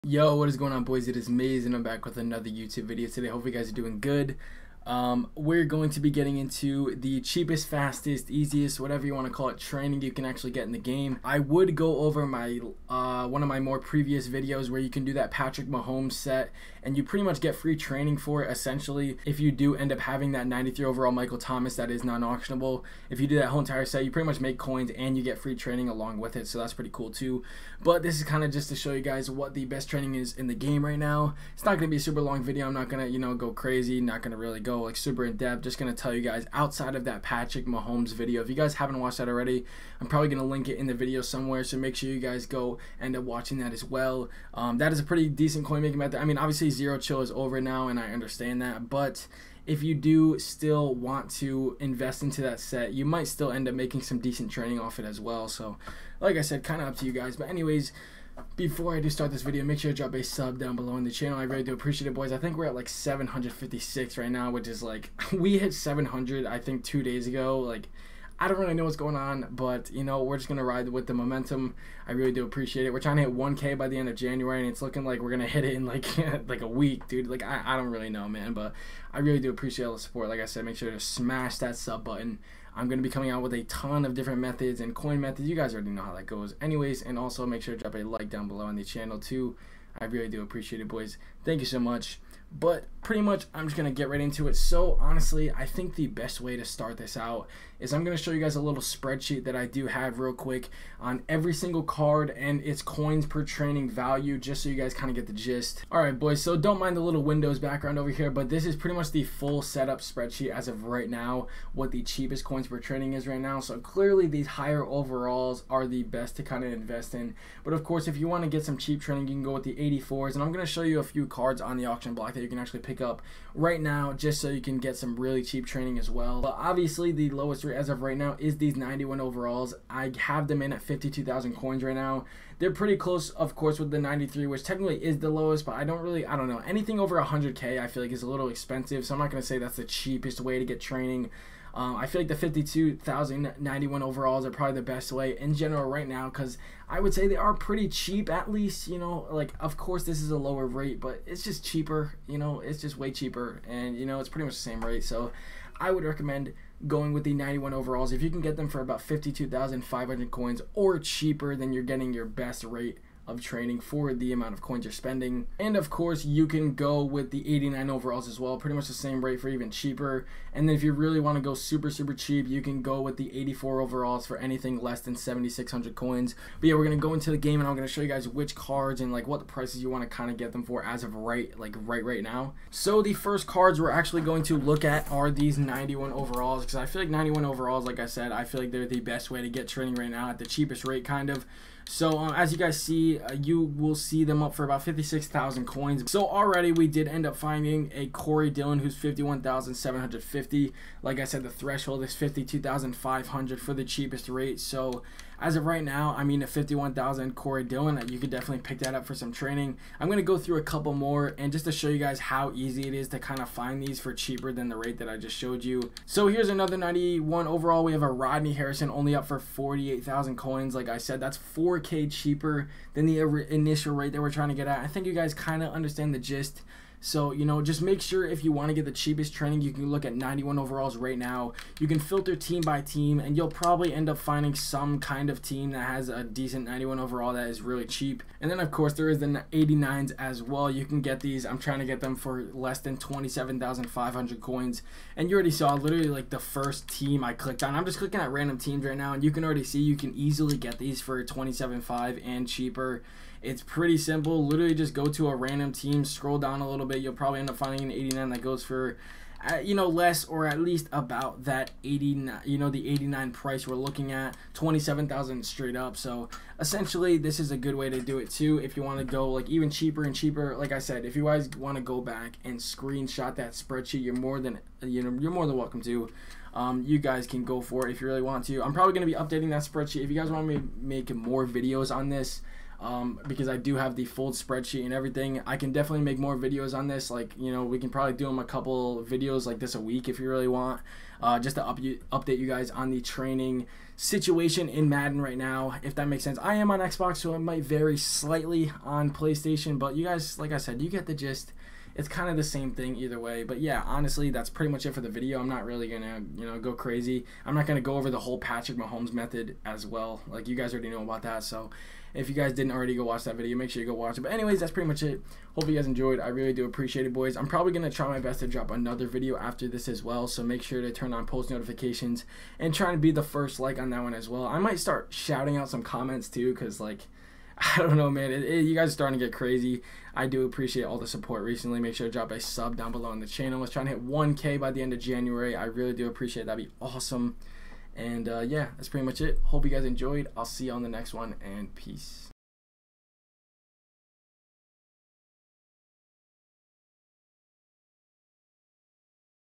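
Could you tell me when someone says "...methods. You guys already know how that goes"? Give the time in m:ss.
1:25.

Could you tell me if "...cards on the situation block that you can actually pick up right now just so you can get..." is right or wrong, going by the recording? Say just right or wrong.
wrong.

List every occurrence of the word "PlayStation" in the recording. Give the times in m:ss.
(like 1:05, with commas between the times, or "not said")
4:59.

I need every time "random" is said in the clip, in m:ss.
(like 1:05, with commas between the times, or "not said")
4:08, 4:15.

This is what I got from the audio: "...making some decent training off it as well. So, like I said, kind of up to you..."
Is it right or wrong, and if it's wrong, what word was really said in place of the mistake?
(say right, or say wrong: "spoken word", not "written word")
right.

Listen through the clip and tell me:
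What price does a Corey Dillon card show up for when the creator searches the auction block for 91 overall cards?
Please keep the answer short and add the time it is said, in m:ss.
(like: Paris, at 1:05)
51,750, at 3:18.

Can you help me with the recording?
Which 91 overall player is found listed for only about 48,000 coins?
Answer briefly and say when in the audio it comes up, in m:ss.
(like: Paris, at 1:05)
Rodney Harrison, at 3:38.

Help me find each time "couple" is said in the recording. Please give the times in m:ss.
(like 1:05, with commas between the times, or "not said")
3:30, 4:48.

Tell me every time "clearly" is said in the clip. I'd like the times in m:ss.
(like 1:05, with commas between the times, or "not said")
1:53.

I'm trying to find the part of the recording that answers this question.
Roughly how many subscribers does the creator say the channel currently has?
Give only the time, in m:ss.
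1:02.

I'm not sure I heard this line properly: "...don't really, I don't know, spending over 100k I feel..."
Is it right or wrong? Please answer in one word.
wrong.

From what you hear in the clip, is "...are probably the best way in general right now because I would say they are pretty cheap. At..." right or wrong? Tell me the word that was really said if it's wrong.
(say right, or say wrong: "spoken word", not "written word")
right.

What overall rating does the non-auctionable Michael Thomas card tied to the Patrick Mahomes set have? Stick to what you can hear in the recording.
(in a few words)
93.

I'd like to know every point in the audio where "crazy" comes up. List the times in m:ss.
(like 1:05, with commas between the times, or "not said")
0:33, 5:06, 5:29.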